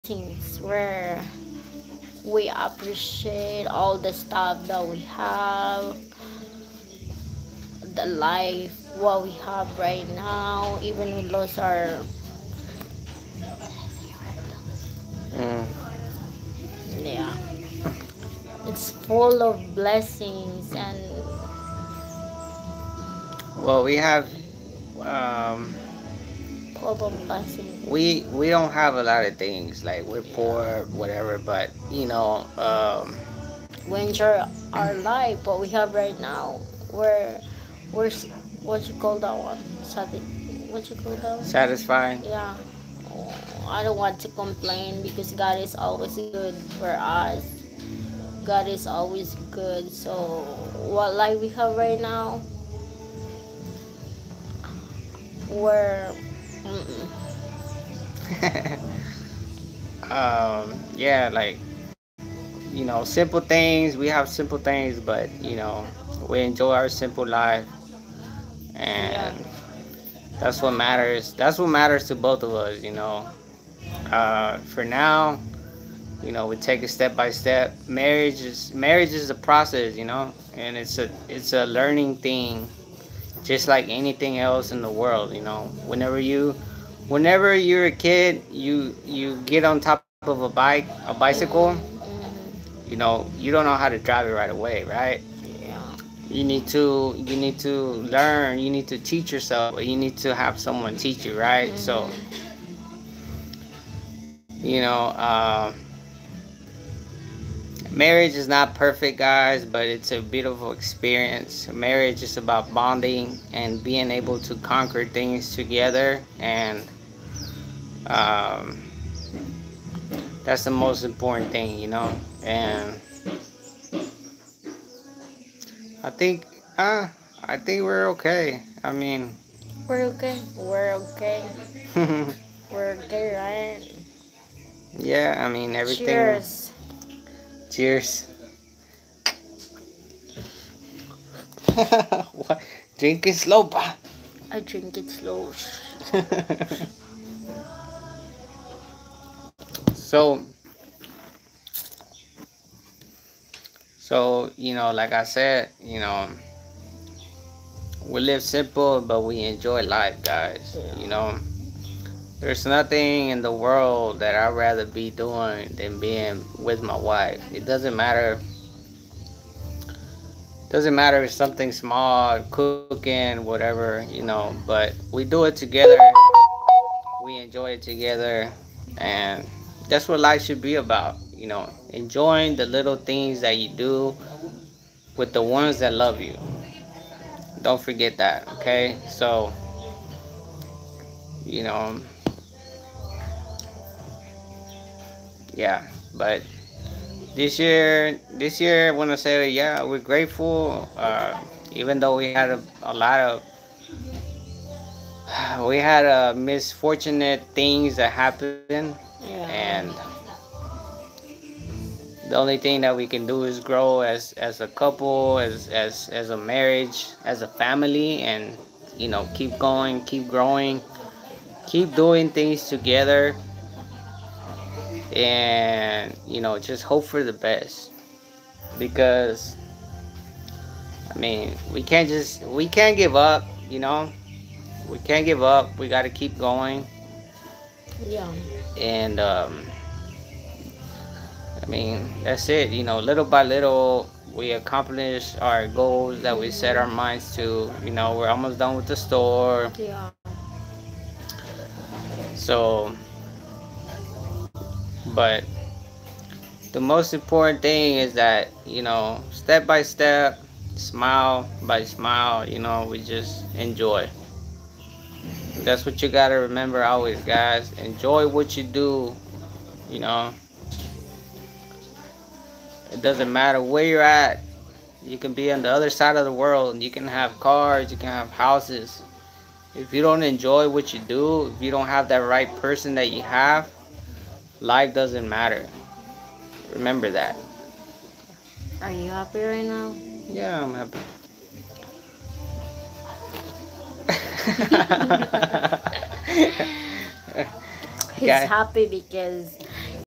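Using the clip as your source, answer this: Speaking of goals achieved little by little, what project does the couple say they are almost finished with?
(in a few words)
the store.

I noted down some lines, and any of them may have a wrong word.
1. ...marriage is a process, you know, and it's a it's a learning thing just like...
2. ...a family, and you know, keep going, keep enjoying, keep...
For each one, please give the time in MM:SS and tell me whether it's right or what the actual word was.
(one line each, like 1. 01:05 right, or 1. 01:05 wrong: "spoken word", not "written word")
1. 01:18 right
2. 03:37 wrong: "growing", not "enjoying".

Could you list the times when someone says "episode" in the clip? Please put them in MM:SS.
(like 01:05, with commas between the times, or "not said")
not said.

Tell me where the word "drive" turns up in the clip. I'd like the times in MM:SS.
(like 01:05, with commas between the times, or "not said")
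01:33.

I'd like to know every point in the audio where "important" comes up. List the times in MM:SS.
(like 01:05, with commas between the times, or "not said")
02:01, 04:17.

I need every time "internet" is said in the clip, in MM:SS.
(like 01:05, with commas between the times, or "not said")
not said.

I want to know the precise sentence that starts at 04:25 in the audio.
That's what you gotta remember always, guys.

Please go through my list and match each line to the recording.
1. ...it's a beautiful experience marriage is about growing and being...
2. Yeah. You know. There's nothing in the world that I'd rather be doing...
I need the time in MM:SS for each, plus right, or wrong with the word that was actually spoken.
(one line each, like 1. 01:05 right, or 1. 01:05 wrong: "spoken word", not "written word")
1. 01:49 wrong: "bonding", not "growing"
2. 02:40 right.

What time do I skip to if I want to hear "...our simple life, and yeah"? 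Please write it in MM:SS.
01:06.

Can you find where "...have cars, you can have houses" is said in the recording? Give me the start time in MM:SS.
04:37.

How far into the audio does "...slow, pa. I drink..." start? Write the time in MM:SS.
02:23.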